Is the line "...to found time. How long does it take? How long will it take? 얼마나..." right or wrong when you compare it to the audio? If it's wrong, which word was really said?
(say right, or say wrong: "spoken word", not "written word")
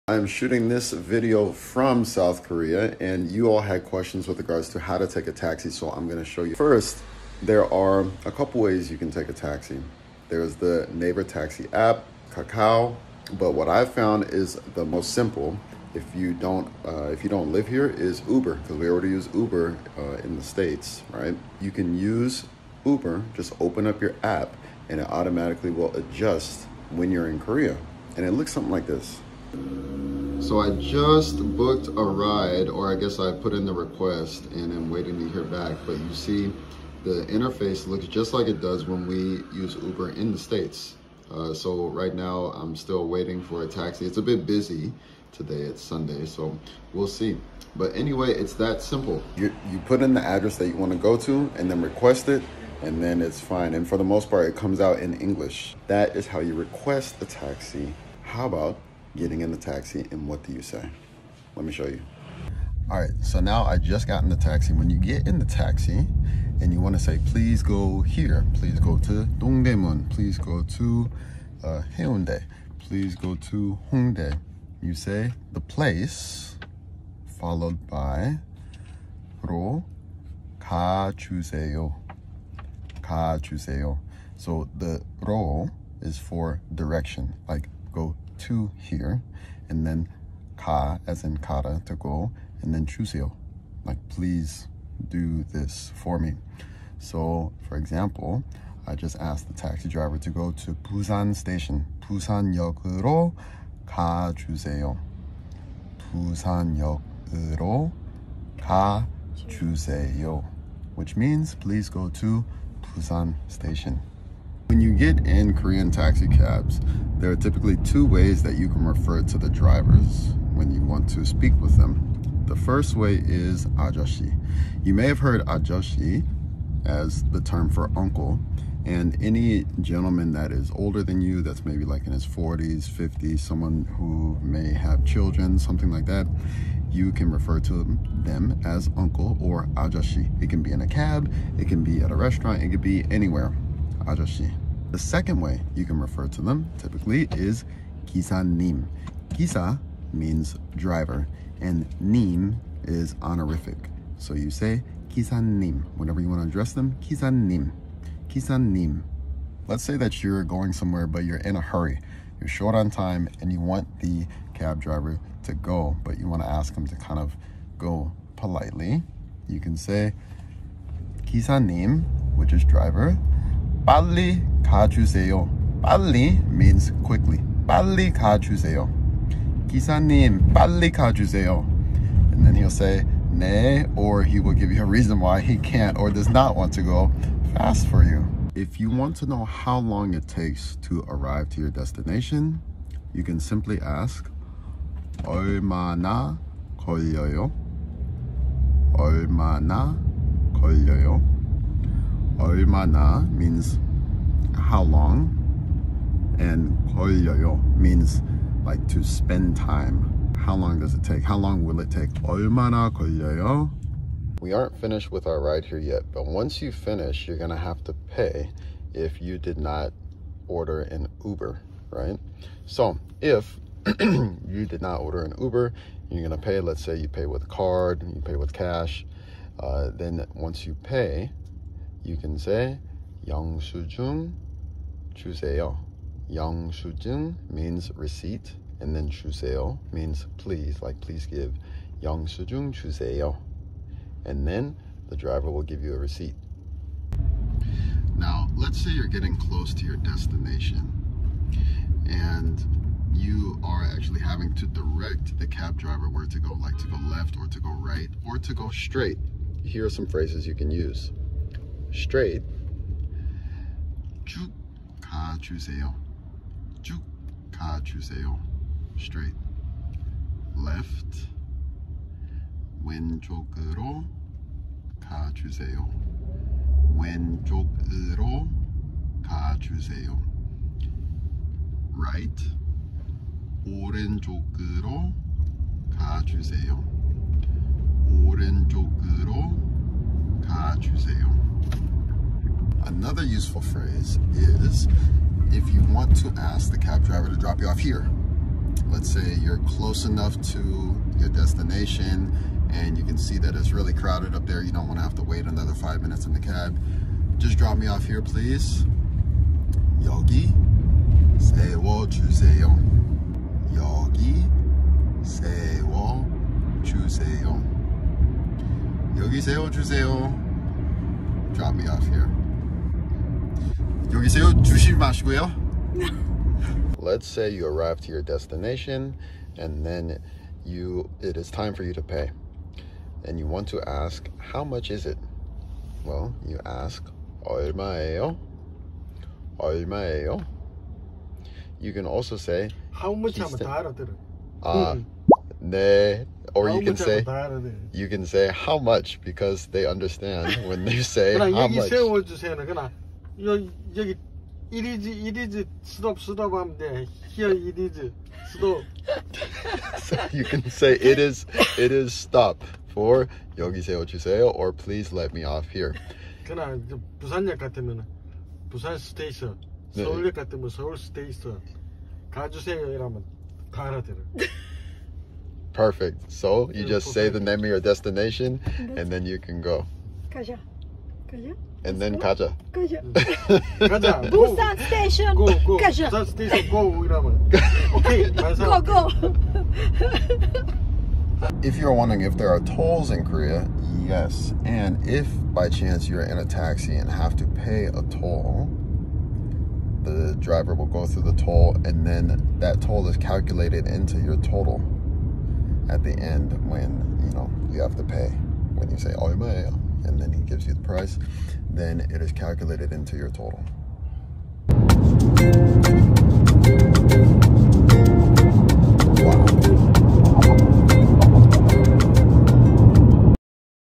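wrong: "spend", not "found".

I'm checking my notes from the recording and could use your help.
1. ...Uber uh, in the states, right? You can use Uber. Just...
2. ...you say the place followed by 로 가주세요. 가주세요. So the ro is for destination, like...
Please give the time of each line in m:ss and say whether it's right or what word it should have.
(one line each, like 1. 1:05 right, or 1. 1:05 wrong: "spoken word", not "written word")
1. 0:19 right
2. 1:14 wrong: "direction", not "destination".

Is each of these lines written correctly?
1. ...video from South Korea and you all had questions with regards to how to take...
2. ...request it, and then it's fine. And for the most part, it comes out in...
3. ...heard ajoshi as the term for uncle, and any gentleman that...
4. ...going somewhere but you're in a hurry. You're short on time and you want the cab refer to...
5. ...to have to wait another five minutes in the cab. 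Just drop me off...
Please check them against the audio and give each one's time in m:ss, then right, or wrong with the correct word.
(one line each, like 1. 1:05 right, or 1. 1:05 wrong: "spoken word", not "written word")
1. 0:00 right
2. 0:51 right
3. 2:05 right
4. 2:40 wrong: "driver", not "refer"
5. 5:04 right.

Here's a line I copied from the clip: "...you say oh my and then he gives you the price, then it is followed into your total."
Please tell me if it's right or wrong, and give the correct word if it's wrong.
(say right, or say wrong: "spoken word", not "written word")
wrong: "calculated", not "followed".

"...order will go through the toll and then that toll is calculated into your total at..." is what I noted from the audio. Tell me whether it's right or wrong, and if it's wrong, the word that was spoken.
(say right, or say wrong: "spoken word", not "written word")
wrong: "driver", not "order".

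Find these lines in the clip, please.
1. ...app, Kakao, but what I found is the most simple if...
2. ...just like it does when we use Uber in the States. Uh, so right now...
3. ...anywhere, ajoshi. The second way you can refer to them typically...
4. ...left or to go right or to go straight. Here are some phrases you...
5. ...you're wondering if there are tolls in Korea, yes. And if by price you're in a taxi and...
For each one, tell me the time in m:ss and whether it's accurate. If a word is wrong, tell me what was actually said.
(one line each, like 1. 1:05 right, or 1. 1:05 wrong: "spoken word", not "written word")
1. 0:11 right
2. 0:38 right
3. 2:23 right
4. 4:17 right
5. 6:31 wrong: "chance", not "price".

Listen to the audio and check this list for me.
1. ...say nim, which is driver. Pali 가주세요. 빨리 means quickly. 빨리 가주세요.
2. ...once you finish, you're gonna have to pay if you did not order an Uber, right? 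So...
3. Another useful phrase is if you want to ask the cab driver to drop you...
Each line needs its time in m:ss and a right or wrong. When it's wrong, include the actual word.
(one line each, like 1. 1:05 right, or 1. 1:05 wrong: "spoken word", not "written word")
1. 2:49 right
2. 3:36 right
3. 4:52 right.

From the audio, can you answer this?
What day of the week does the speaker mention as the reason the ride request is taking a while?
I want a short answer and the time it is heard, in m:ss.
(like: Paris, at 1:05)
Sunday, at 0:45.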